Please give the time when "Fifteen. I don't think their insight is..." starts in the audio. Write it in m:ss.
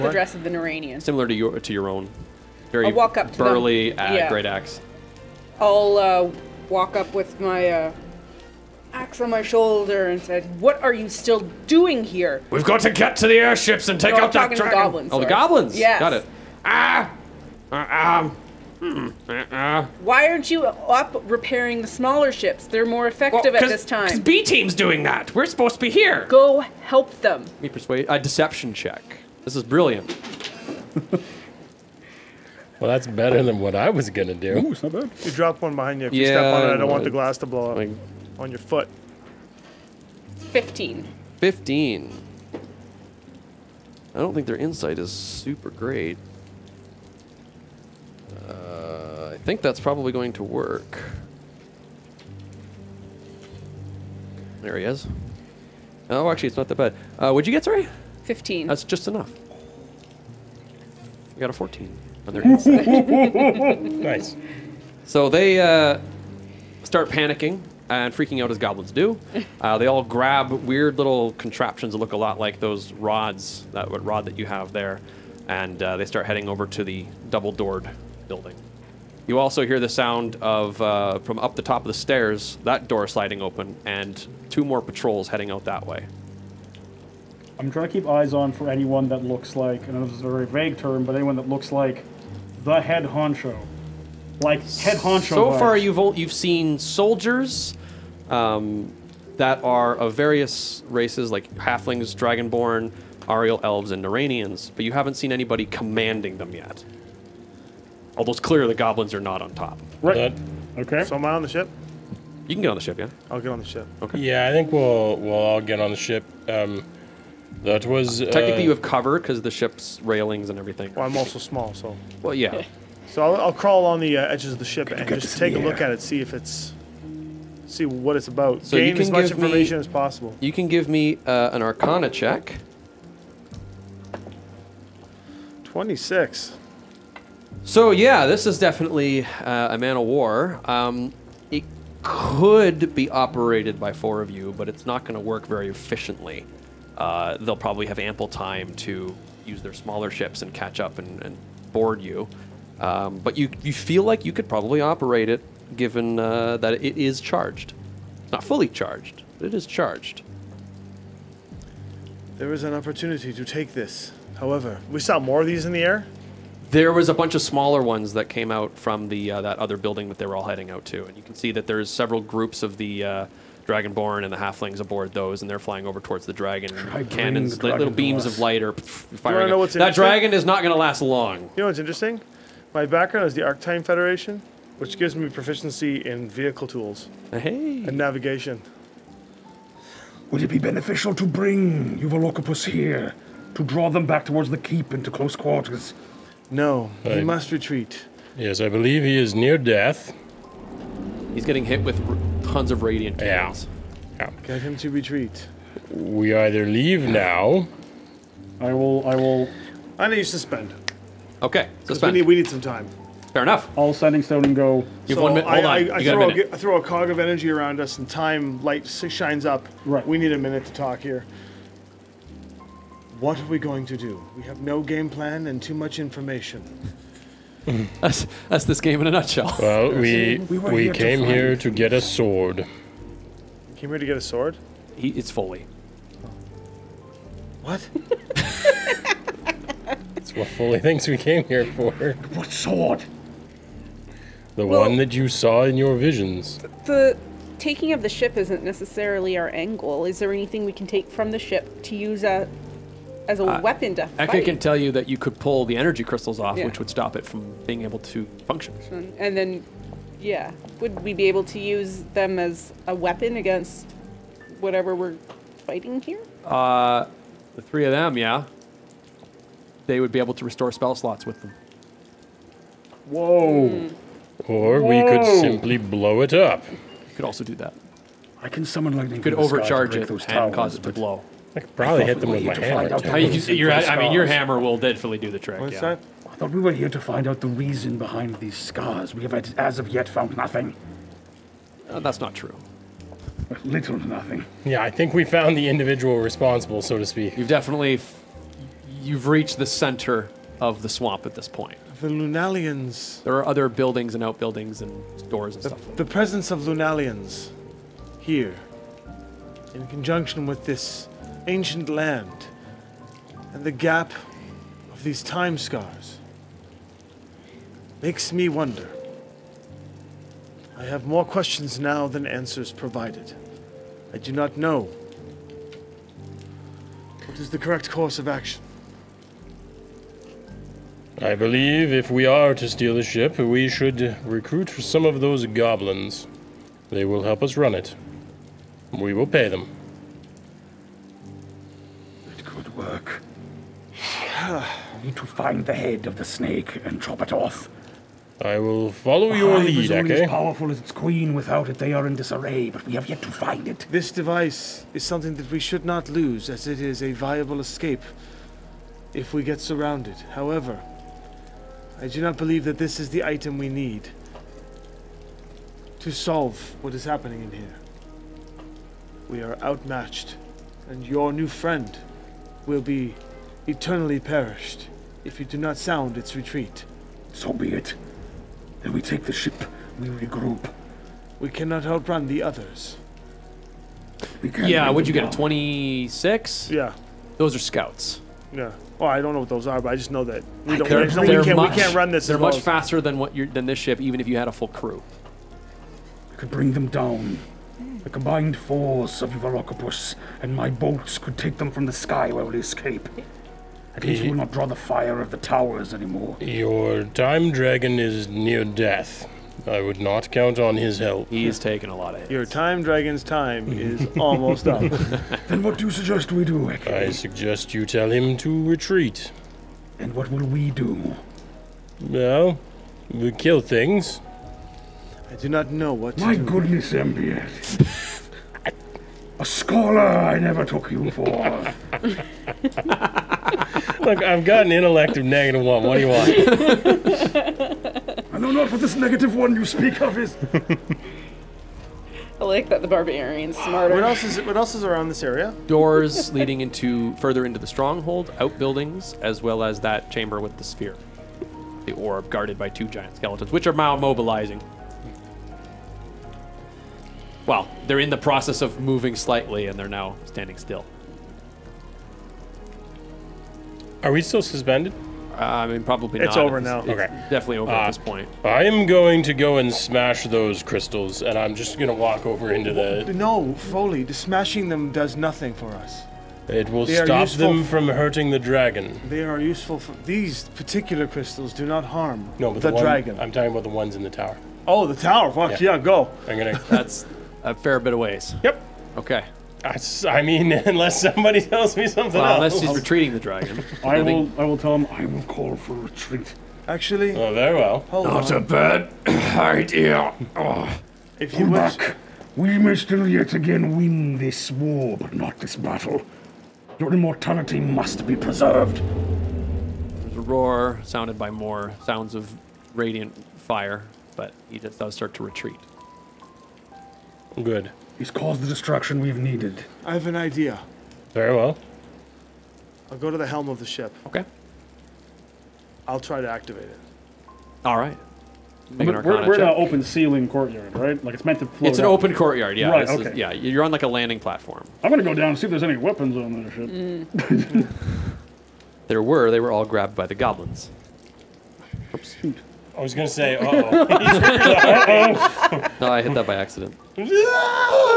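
0:41.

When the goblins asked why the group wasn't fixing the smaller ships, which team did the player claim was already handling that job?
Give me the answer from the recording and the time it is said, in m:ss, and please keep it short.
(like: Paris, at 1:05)
B team, at 0:24.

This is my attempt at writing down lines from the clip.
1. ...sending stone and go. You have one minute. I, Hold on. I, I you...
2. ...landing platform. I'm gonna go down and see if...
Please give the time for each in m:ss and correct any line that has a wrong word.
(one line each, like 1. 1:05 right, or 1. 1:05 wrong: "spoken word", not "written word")
1. 3:33 right
2. 8:53 right.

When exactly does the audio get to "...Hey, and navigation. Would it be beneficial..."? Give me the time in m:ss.
3:07.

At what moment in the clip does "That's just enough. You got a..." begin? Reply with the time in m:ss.
0:58.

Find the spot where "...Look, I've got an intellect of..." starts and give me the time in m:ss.
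7:11.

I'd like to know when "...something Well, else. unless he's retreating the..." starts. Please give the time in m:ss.
8:11.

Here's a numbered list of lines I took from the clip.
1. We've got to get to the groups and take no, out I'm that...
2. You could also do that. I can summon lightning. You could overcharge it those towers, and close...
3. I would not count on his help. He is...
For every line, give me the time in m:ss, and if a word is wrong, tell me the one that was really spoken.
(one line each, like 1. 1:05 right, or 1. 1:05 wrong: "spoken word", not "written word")
1. 0:12 wrong: "airships", not "groups"
2. 4:36 wrong: "cause", not "close"
3. 6:49 right.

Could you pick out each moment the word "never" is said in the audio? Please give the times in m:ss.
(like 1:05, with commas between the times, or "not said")
7:10.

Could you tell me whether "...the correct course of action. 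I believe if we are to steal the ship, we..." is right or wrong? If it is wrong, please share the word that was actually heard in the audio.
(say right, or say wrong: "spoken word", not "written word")
right.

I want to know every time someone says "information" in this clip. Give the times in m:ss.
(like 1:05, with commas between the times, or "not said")
2:09, 3:45.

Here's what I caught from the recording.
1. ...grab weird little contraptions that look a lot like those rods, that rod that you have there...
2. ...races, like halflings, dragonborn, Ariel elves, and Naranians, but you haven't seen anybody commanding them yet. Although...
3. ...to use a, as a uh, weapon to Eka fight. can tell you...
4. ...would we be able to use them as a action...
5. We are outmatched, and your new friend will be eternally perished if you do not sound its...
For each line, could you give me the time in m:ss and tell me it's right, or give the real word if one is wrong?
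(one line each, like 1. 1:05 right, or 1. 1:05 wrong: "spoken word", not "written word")
1. 1:10 right
2. 1:40 right
3. 4:11 right
4. 4:20 wrong: "weapon", not "action"
5. 6:09 right.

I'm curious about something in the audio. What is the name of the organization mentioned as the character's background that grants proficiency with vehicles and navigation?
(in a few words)
Arctime Federation.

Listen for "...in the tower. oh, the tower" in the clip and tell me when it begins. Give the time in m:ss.
8:03.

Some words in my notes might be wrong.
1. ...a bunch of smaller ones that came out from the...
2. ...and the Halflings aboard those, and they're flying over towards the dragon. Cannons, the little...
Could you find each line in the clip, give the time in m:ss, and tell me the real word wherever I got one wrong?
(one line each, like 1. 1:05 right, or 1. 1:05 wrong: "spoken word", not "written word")
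1. 2:47 right
2. 2:54 right.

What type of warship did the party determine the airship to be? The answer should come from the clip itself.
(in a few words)
Man of war.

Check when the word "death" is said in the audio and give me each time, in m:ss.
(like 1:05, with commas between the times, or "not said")
3:19, 6:48.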